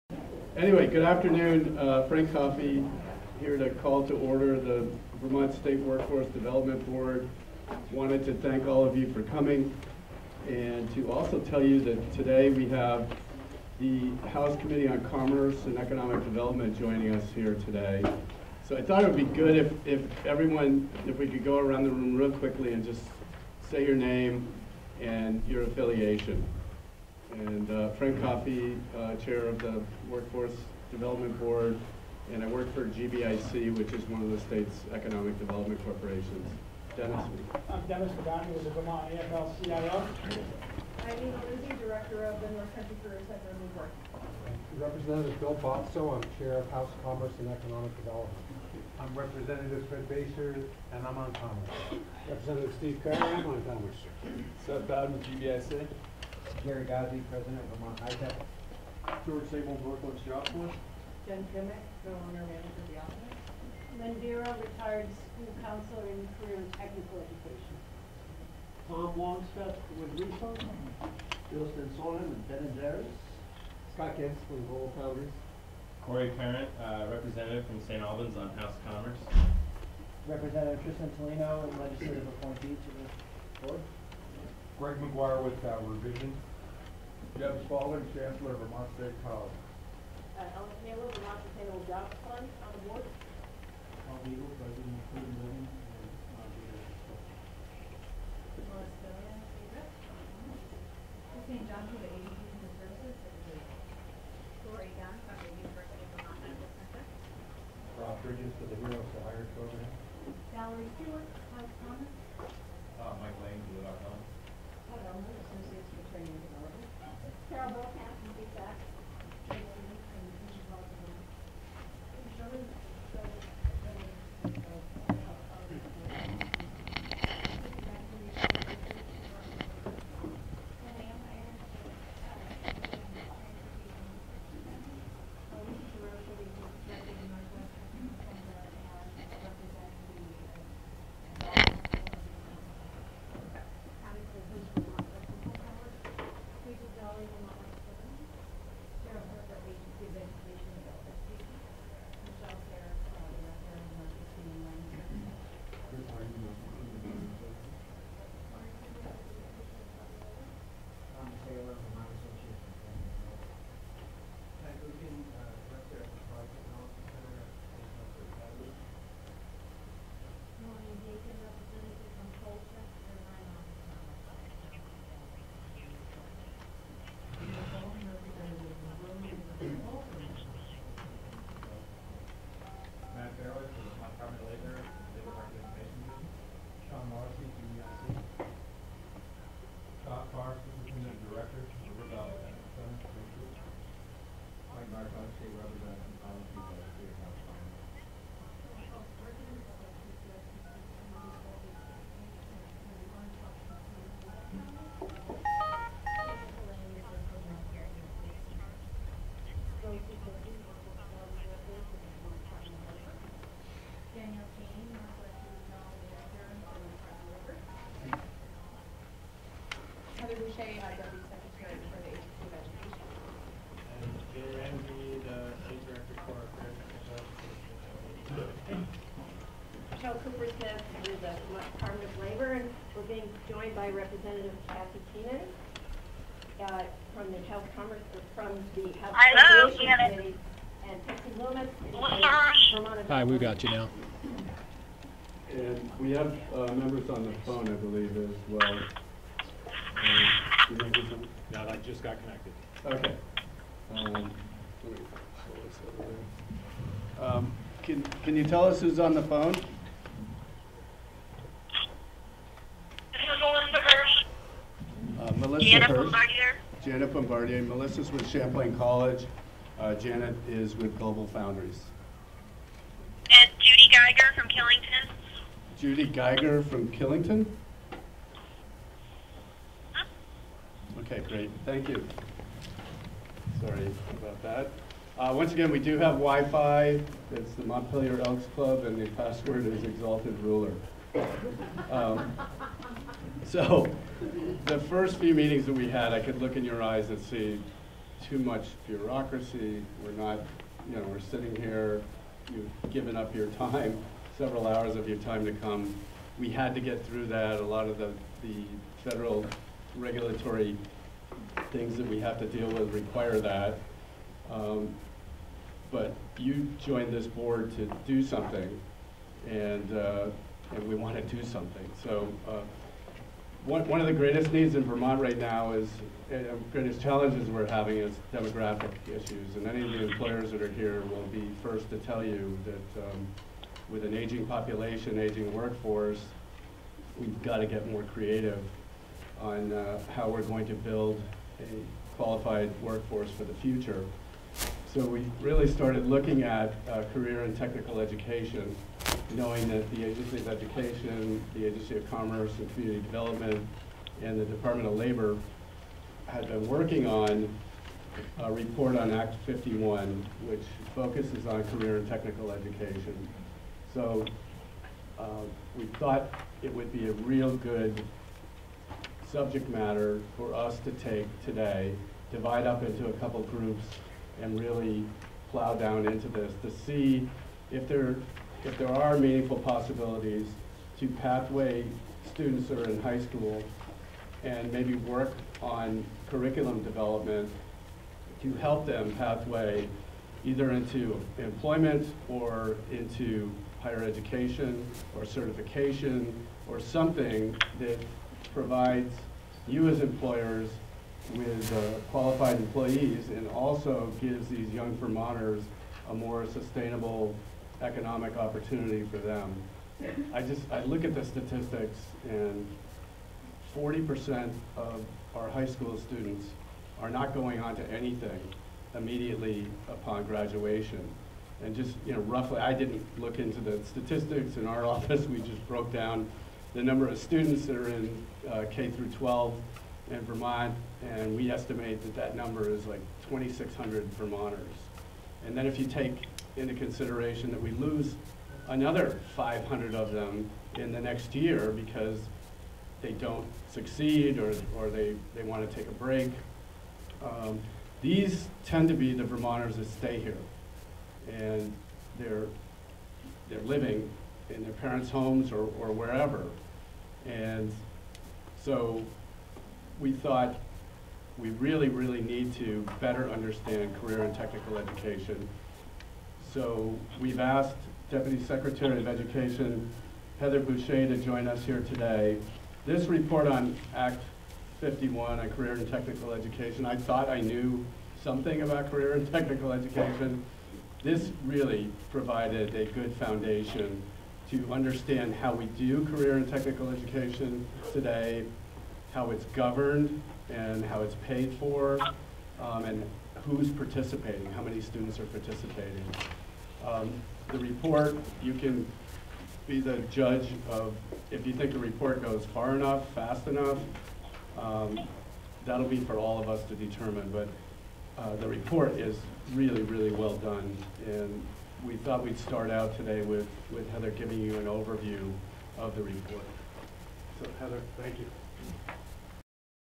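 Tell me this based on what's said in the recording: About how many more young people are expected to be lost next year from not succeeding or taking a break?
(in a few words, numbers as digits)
500.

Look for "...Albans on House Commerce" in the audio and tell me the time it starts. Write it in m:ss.
1:18.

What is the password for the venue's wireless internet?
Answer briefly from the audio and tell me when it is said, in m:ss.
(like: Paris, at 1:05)
Exalted Ruler, at 4:49.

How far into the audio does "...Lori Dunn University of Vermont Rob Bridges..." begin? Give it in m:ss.
1:44.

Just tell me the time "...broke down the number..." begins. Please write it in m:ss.
7:05.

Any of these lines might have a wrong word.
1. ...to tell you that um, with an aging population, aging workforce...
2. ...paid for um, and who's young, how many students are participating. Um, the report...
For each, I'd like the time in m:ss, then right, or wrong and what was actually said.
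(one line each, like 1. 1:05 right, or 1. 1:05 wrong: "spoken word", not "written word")
1. 5:31 right
2. 8:11 wrong: "participating", not "young".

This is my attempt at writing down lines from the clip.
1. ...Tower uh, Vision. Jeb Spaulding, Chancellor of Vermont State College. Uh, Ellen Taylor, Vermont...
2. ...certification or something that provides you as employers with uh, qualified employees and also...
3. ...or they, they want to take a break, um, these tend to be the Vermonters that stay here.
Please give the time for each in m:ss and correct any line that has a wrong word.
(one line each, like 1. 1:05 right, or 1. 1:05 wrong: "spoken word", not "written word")
1. 1:25 right
2. 6:35 right
3. 7:24 right.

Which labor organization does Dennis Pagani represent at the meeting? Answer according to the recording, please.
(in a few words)
Vermont AFL-CIO.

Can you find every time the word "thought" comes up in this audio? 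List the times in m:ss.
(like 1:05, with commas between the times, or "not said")
0:18, 6:05, 7:40, 7:56, 8:31.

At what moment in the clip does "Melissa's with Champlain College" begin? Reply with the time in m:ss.
4:27.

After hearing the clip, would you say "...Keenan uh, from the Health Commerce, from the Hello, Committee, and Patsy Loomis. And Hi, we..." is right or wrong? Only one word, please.
right.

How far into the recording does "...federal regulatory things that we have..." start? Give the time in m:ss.
5:09.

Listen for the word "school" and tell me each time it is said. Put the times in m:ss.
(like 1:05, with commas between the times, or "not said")
1:05, 6:23, 6:55.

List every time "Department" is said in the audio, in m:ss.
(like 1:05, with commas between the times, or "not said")
3:51, 5:54.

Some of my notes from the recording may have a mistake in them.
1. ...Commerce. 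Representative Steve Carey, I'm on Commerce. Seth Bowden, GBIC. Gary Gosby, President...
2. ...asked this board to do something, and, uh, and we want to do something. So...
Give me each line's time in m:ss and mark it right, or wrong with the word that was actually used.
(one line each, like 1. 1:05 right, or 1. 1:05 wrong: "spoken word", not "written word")
1. 0:51 right
2. 5:16 wrong: "joined", not "asked".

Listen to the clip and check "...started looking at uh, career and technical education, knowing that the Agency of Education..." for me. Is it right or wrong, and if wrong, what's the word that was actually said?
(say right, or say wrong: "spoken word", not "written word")
right.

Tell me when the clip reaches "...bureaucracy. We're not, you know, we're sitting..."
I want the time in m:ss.
4:58.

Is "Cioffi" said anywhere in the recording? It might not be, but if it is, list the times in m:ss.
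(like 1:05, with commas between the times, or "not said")
0:02, 0:28.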